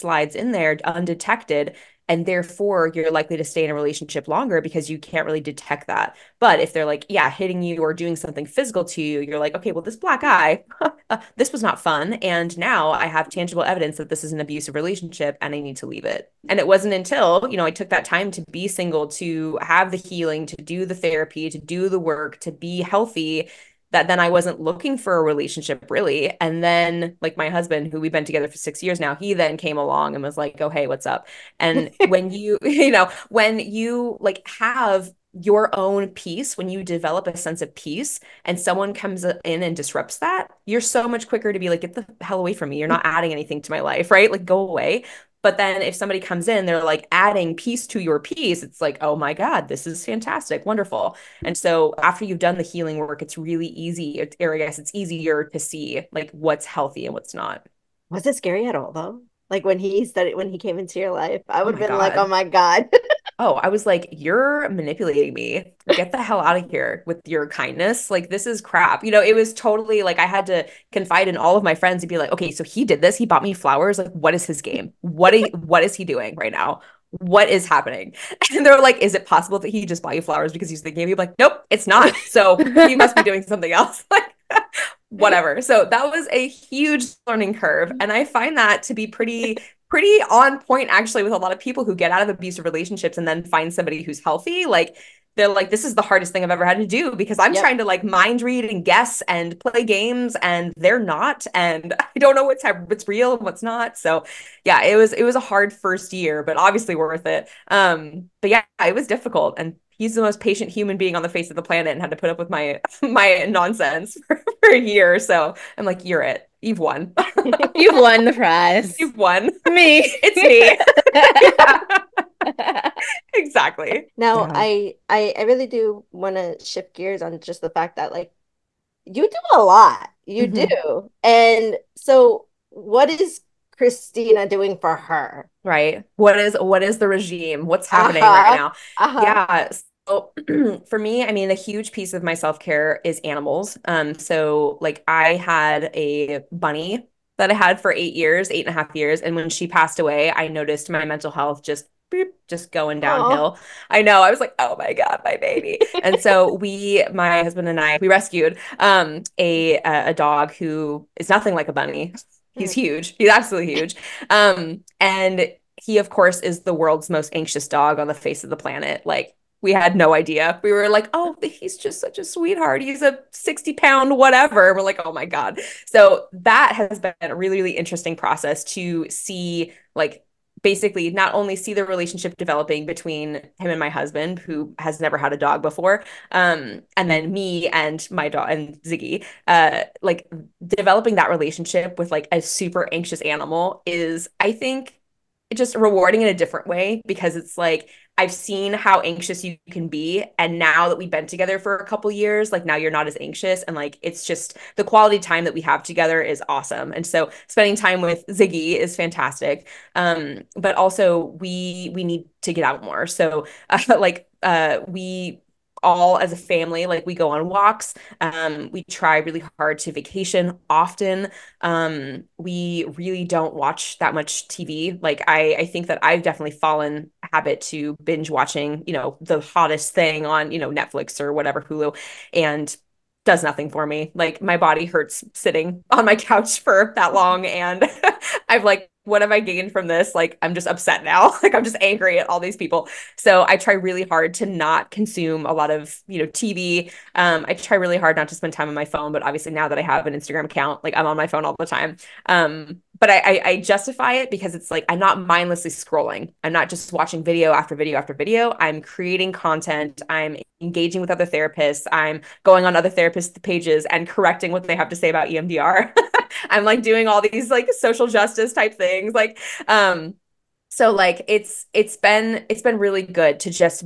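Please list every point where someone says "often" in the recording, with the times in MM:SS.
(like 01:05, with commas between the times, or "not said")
03:40.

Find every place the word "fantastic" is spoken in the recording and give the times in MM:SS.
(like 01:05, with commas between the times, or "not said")
00:50, 03:28.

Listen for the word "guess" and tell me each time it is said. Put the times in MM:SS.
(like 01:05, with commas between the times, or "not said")
00:54, 01:38.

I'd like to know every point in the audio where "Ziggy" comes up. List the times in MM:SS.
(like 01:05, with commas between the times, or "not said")
03:08, 03:28.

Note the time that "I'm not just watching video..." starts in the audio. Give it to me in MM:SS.
04:16.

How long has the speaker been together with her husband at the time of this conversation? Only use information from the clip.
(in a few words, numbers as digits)
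6 years.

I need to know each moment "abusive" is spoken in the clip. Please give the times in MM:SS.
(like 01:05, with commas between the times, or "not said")
00:14, 01:32.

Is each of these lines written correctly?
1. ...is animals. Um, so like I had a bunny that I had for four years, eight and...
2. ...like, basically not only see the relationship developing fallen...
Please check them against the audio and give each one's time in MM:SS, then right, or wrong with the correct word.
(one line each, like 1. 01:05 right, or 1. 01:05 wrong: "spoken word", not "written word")
1. 02:23 wrong: "eight", not "four"
2. 02:59 wrong: "between", not "fallen".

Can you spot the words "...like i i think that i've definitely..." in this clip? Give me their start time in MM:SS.
03:45.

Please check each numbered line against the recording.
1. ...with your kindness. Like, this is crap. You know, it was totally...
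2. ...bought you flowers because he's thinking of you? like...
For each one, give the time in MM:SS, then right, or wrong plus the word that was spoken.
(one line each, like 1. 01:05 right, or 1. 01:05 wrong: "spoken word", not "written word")
1. 01:07 right
2. 01:20 right.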